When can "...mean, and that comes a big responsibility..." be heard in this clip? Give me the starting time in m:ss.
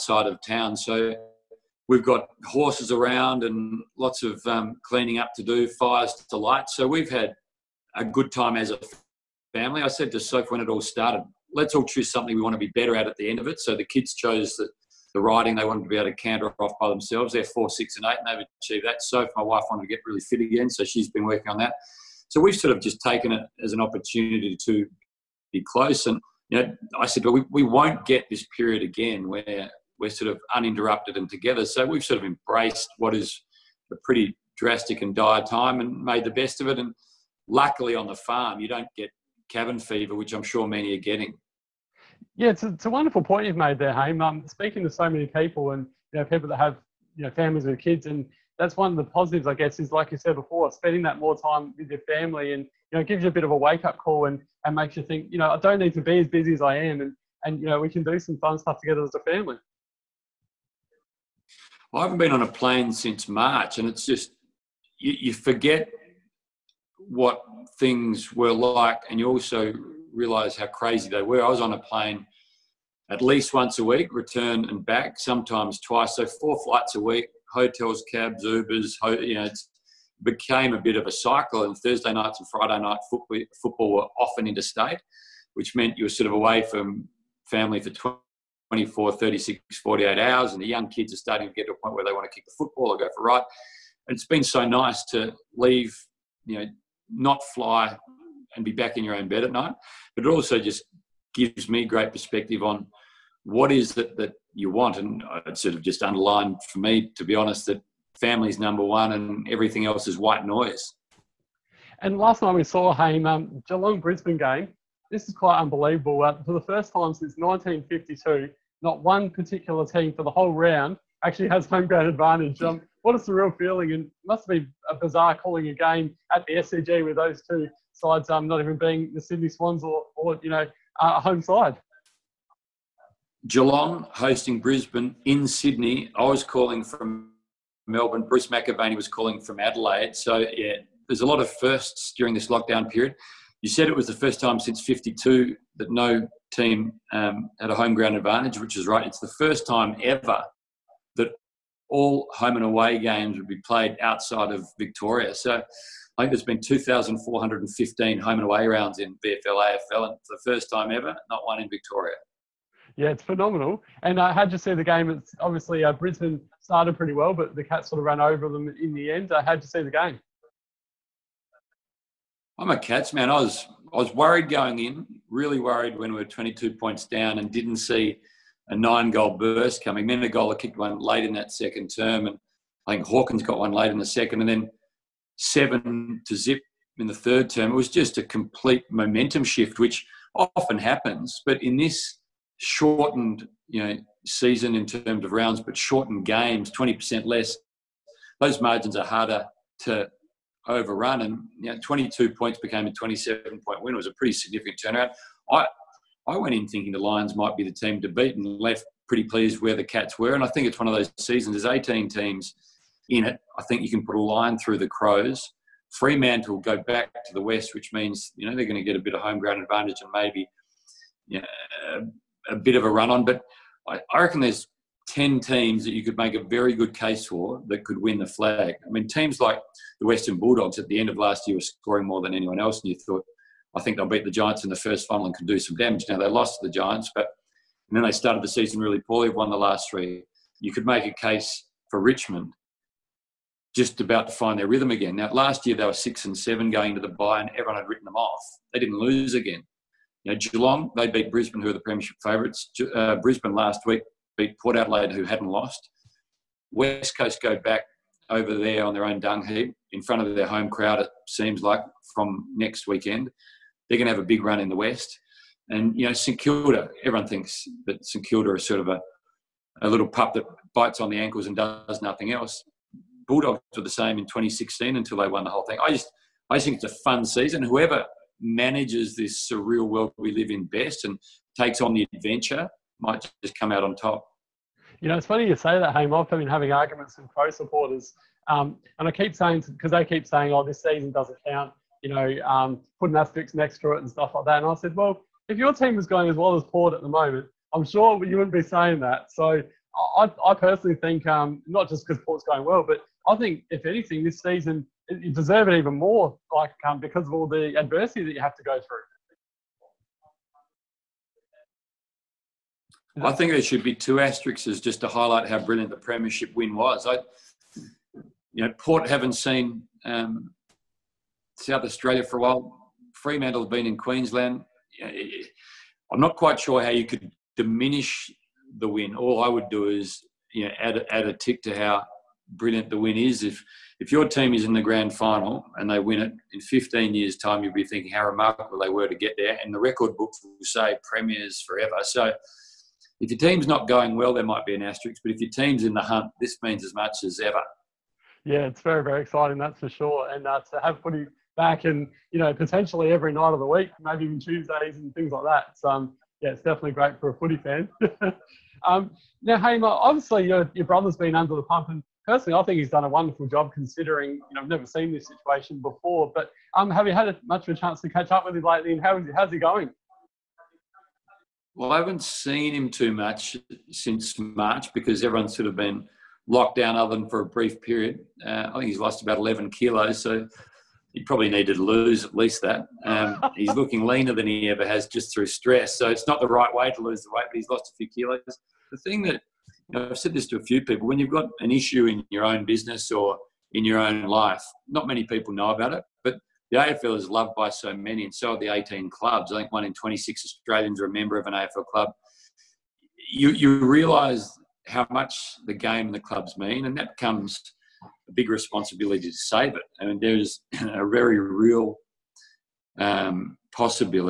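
6:46.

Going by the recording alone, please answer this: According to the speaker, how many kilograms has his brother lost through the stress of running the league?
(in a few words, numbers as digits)
11.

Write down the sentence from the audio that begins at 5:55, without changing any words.
So um, yeah, it's definitely great for a footy fan.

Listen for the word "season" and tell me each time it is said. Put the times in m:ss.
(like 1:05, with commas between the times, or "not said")
3:14, 3:31, 3:58, 4:37, 4:50, 5:04.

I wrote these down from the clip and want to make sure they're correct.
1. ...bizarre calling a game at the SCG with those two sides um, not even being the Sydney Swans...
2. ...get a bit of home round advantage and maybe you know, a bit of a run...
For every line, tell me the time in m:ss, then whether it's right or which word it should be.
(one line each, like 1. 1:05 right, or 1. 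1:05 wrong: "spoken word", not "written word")
1. 2:04 right
2. 3:38 wrong: "ground", not "round".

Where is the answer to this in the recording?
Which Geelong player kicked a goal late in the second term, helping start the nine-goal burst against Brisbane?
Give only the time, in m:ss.
3:00.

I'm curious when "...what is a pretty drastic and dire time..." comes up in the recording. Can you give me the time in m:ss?
0:32.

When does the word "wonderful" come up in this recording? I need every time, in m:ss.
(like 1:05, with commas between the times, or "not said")
0:42, 6:03.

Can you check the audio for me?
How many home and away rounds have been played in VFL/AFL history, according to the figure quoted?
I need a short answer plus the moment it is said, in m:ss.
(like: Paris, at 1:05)
2,415, at 2:36.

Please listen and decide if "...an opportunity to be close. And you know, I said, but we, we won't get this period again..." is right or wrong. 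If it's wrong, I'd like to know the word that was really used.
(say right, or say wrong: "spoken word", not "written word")
right.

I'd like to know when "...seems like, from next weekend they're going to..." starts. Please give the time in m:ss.
4:21.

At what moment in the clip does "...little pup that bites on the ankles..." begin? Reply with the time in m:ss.
4:29.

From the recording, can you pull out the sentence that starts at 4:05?
Now, last year they were six and seven going to the bye, and everyone had written them off.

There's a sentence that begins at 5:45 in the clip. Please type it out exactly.
But if your team's in the hunt, this means as much as ever.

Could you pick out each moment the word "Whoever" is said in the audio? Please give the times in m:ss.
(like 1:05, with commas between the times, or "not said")
4:37.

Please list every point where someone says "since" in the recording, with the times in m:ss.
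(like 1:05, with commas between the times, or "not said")
1:02, 1:57, 2:24, 6:13.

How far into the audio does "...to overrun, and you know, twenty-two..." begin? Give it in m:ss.
3:19.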